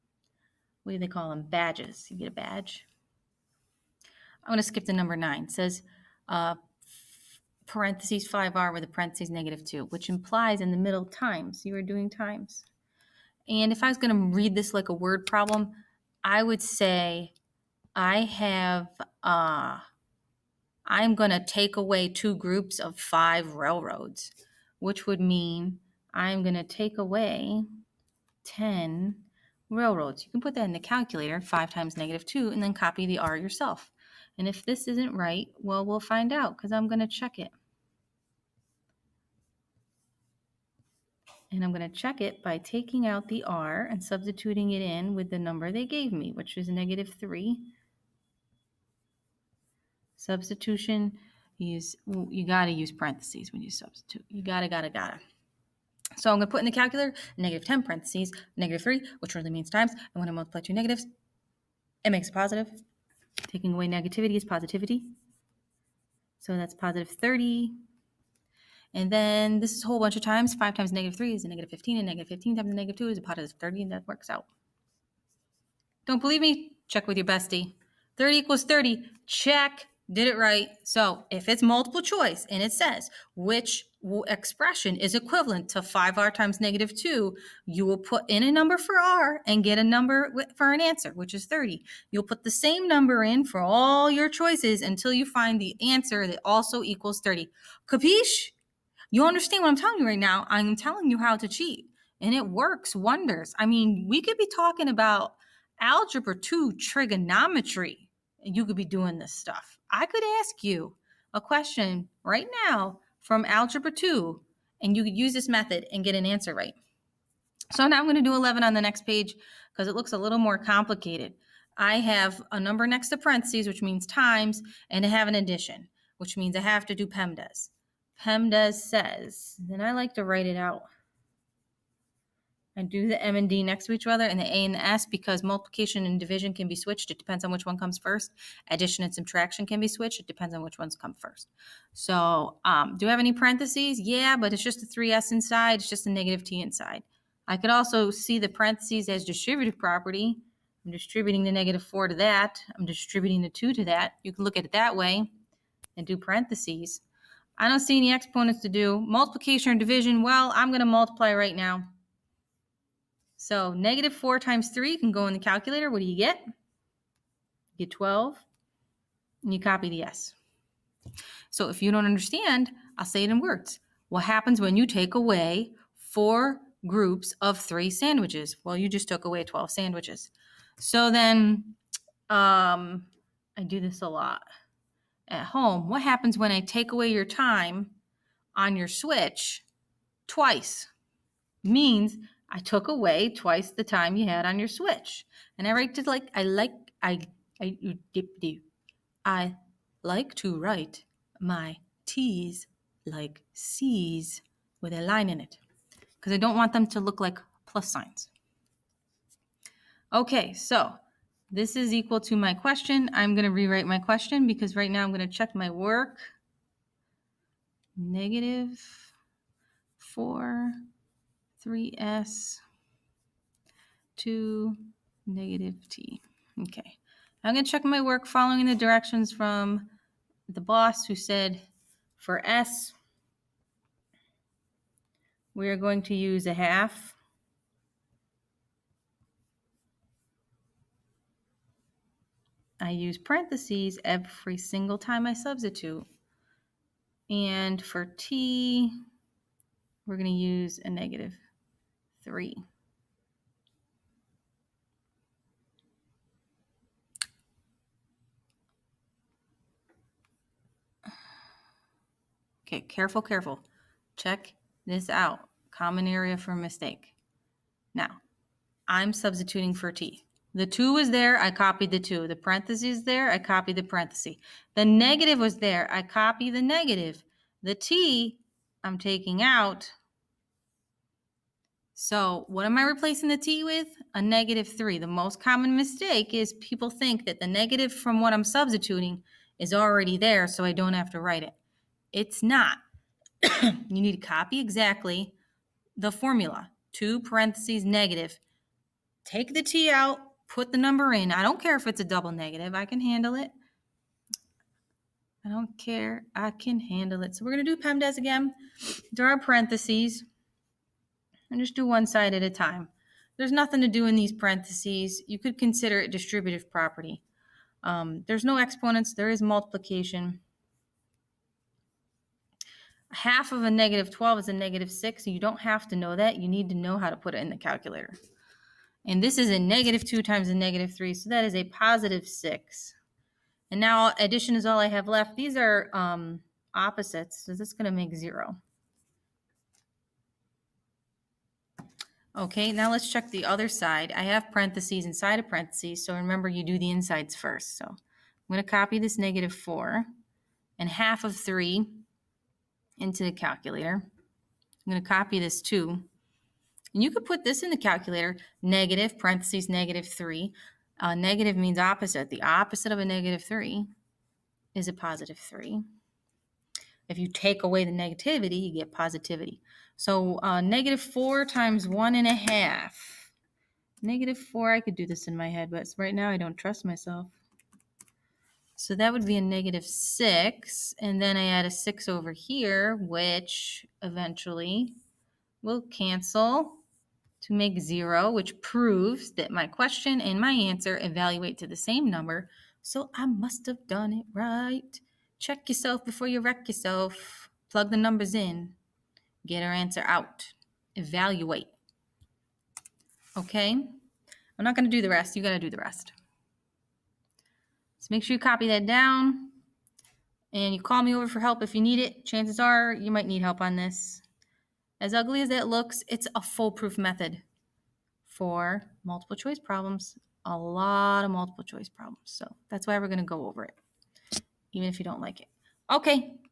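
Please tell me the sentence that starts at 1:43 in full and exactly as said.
I mean, we could be talking about algebra 2 trigonometry, and you could be doing this stuff.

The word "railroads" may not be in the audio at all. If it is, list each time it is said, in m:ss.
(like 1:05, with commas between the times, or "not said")
0:23, 0:29.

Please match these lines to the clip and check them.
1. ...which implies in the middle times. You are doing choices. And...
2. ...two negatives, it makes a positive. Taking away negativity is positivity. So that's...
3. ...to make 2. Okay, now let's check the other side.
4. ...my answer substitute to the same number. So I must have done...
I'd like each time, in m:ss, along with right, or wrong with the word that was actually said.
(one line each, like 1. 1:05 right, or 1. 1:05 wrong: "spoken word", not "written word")
1. 0:09 wrong: "times", not "choices"
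2. 1:00 right
3. 5:37 wrong: "0", not "2"
4. 6:30 wrong: "evaluate", not "substitute".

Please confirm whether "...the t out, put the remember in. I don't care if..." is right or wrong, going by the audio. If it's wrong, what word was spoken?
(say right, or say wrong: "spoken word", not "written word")
wrong: "number", not "remember".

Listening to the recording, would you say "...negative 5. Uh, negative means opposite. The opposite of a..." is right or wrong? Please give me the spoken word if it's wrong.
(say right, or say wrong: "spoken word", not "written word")
wrong: "3", not "5".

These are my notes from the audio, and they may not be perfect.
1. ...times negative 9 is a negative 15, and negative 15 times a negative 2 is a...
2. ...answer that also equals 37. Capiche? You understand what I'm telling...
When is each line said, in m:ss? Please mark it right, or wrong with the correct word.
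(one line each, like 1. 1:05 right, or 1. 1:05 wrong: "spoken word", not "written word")
1. 1:10 wrong: "3", not "9"
2. 1:35 wrong: "30", not "37".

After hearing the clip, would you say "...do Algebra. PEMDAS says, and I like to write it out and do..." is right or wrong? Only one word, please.
wrong.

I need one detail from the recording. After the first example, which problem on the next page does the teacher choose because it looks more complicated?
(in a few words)
11.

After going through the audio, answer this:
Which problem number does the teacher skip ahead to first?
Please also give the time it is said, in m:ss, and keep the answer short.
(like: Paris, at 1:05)
9, at 0:04.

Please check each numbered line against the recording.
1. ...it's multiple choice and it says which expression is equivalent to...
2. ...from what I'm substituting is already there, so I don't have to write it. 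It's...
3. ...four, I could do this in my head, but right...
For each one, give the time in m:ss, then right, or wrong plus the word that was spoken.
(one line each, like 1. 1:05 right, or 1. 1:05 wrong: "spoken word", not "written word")
1. 1:21 right
2. 4:47 right
3. 6:14 right.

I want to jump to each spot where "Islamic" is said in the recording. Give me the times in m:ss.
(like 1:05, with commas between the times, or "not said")
not said.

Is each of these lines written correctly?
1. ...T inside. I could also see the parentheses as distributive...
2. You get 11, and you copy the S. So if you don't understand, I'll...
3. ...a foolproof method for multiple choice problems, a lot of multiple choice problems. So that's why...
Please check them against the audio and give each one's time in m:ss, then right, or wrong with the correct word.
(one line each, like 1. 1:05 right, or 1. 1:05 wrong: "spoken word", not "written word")
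1. 2:26 right
2. 2:46 wrong: "12", not "11"
3. 6:56 right.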